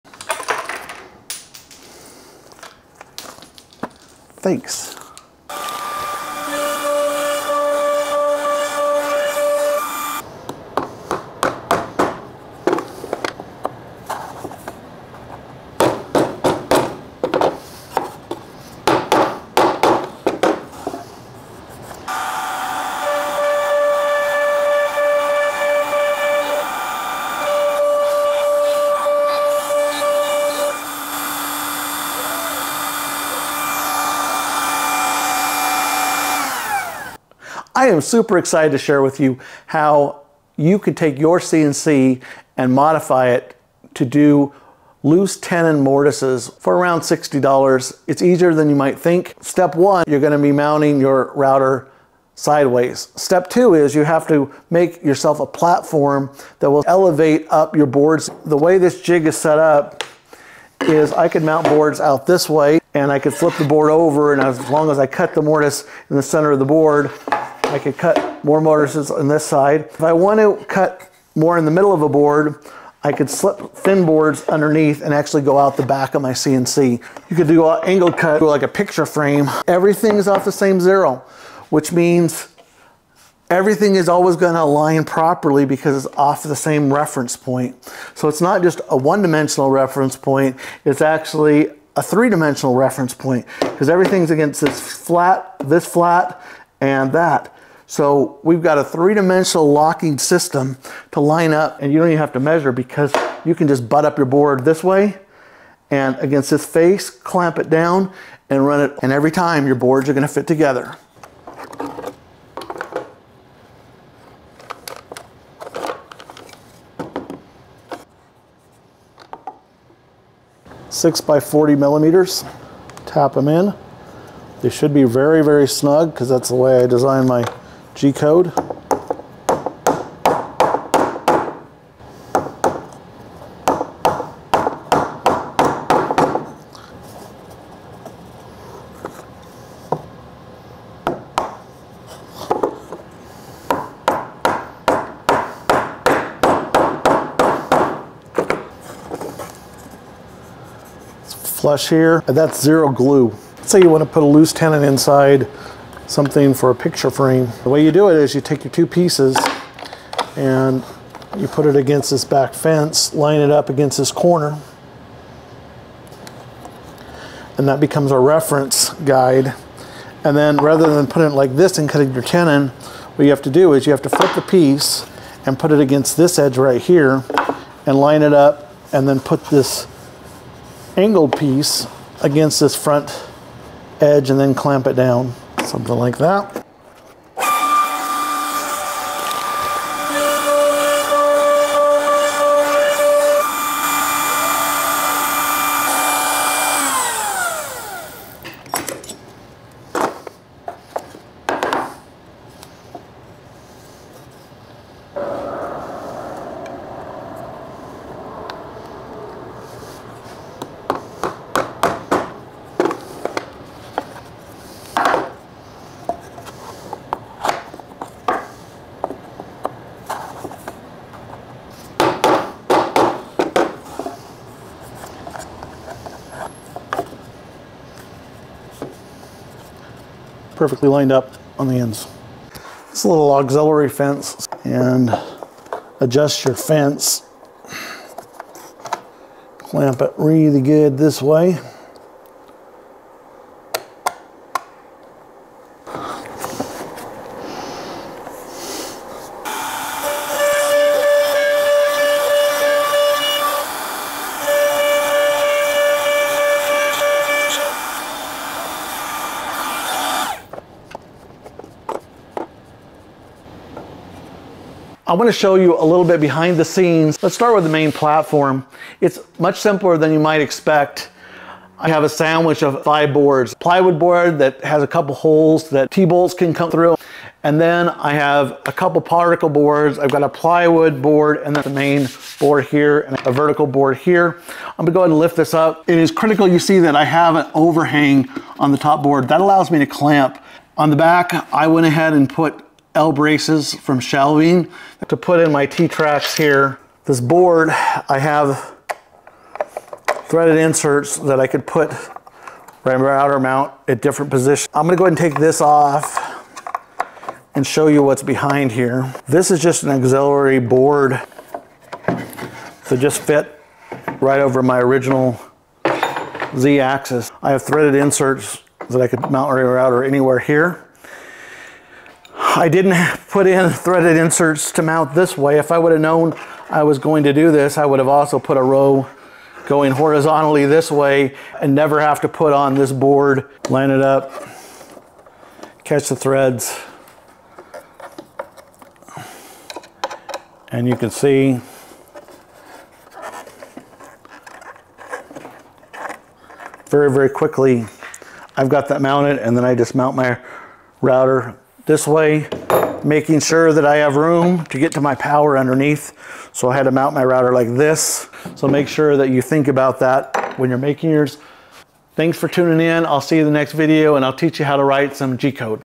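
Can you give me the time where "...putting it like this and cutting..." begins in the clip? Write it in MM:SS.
02:51.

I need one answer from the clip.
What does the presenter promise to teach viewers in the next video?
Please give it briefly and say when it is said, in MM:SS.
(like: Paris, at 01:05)
G-code, at 06:05.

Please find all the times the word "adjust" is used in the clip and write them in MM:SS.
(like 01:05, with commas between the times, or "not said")
03:55.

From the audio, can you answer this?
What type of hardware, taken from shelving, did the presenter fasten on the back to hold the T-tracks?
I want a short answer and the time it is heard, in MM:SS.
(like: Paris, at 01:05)
L braces, at 04:52.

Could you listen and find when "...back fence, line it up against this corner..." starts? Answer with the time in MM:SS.
02:42.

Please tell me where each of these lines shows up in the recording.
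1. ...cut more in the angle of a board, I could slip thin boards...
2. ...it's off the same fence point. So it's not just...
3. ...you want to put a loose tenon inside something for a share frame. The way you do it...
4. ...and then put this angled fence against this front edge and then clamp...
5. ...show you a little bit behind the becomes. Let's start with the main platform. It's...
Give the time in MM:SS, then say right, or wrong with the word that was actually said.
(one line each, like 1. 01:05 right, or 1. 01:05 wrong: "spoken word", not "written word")
1. 01:10 wrong: "middle", not "angle"
2. 01:26 wrong: "reference", not "fence"
3. 02:33 wrong: "picture", not "share"
4. 02:58 wrong: "piece", not "fence"
5. 04:25 wrong: "scenes", not "becomes".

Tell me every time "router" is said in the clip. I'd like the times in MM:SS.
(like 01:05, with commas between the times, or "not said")
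00:51, 05:02, 05:19, 05:51, 05:57.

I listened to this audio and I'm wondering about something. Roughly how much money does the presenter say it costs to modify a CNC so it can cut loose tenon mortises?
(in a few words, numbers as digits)
$60.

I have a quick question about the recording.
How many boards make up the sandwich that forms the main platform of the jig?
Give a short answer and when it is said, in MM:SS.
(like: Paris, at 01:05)
5, at 04:32.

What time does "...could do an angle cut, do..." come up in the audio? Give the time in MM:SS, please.
01:17.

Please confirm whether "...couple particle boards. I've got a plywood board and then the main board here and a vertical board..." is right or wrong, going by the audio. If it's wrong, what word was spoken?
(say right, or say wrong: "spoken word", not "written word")
right.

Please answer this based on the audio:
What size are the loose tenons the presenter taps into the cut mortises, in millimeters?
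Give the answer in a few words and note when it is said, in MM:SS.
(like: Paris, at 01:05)
6 by 40 millimeters, at 02:00.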